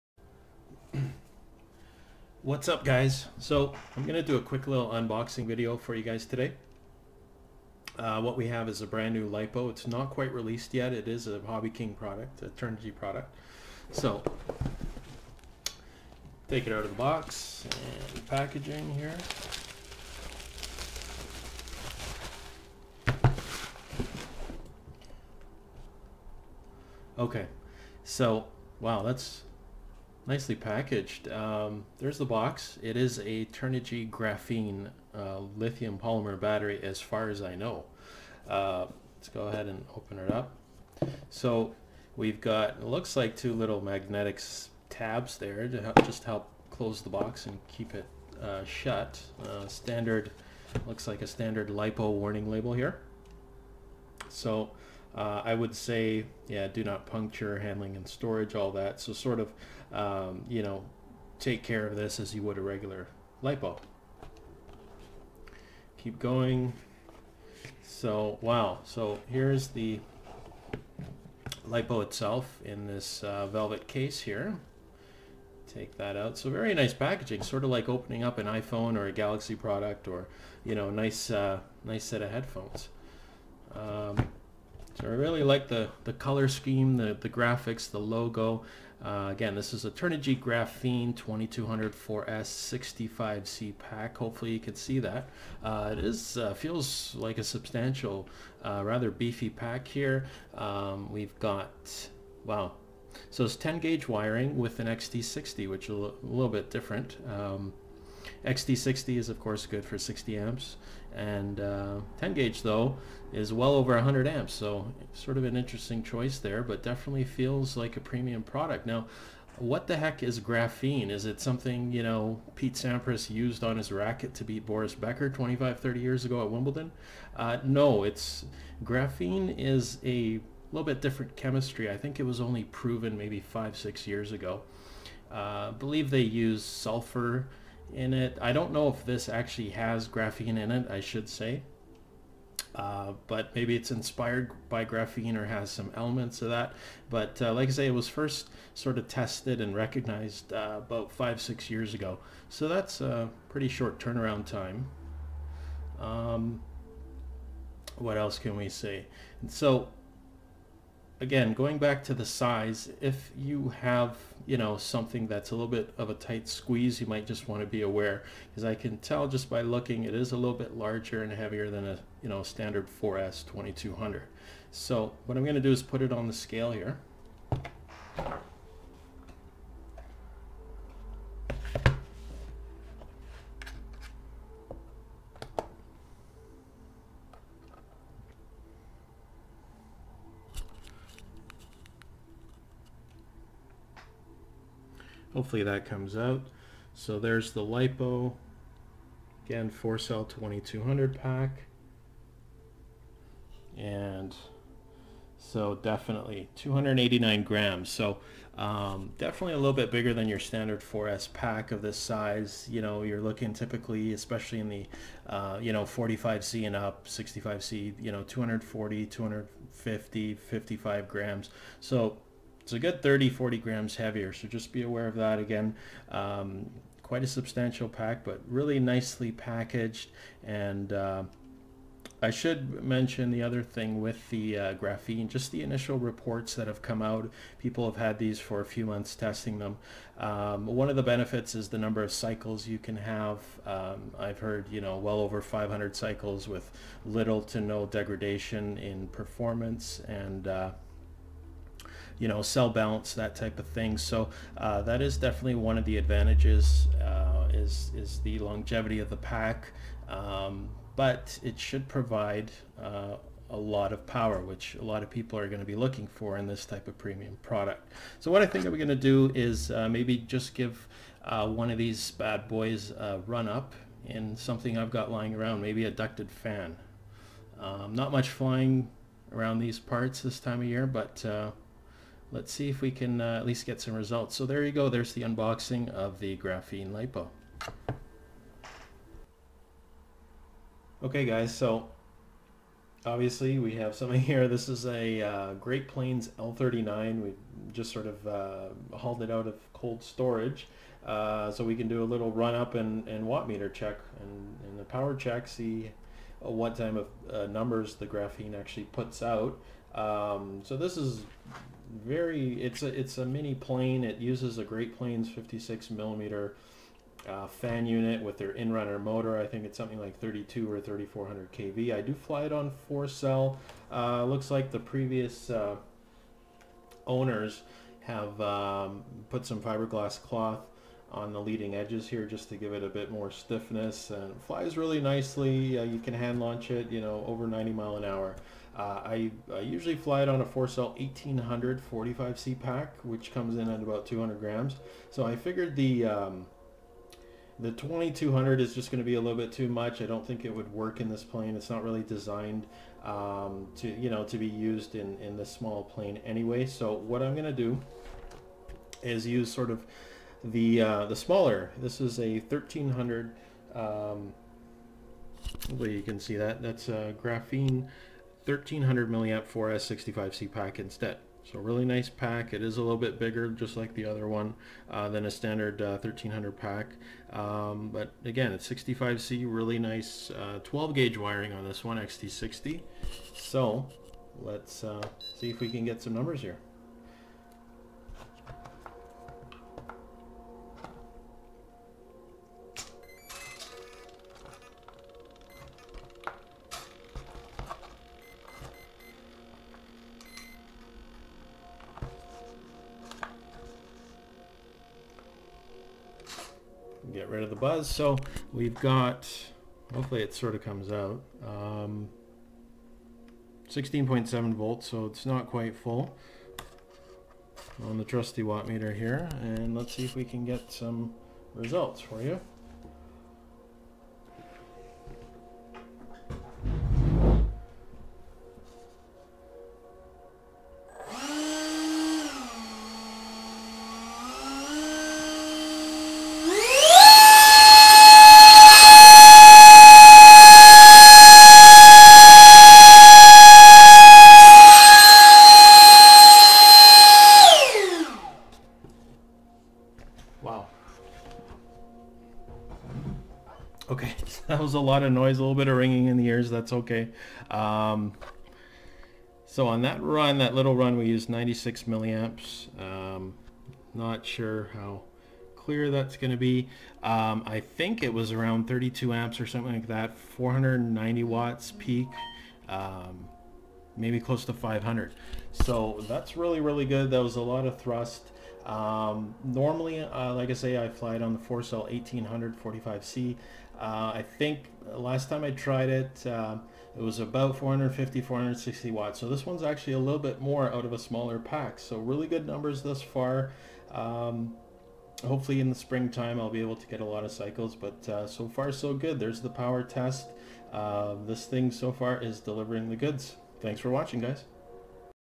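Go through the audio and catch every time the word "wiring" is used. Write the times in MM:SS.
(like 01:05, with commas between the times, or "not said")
01:44, 06:21.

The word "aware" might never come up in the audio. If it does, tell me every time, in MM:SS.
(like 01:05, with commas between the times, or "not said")
02:47, 03:44.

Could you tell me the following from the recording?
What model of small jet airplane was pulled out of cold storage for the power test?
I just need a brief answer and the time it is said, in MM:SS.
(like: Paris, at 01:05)
Great Planes L39, at 04:55.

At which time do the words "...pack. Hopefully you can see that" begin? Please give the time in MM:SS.
01:33.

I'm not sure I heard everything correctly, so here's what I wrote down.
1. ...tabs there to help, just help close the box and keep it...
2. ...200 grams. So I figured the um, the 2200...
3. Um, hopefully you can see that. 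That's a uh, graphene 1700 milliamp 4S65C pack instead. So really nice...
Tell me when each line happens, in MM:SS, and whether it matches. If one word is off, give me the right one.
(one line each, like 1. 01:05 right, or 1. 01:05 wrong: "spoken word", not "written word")
1. 00:44 right
2. 05:44 right
3. 06:03 wrong: "1300", not "1700".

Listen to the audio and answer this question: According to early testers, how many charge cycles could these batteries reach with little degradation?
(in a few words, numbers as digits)
over 500.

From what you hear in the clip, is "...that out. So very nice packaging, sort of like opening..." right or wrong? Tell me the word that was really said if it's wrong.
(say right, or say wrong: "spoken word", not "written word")
right.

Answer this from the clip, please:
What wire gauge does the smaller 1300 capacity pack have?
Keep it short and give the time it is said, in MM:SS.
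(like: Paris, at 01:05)
12 gauge, at 06:20.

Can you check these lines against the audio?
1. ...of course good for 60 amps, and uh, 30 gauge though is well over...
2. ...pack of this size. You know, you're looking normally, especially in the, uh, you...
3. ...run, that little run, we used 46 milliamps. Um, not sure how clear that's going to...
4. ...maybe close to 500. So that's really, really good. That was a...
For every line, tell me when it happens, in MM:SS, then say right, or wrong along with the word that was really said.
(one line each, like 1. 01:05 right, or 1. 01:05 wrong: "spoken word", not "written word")
1. 01:49 wrong: "10", not "30"
2. 03:31 wrong: "typically", not "normally"
3. 07:40 wrong: "96", not "46"
4. 07:53 right.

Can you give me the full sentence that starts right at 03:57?
People have had these for a few months testing them.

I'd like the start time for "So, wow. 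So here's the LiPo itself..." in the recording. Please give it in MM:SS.
01:07.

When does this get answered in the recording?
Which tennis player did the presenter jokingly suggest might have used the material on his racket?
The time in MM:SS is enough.
02:02.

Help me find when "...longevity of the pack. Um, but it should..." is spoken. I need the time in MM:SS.
04:18.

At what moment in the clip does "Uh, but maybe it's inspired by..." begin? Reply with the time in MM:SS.
02:22.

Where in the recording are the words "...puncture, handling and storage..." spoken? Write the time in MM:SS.
00:57.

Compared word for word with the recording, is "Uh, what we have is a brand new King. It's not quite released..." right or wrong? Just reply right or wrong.
wrong.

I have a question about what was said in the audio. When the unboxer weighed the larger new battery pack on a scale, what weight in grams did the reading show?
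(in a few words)
289 grams.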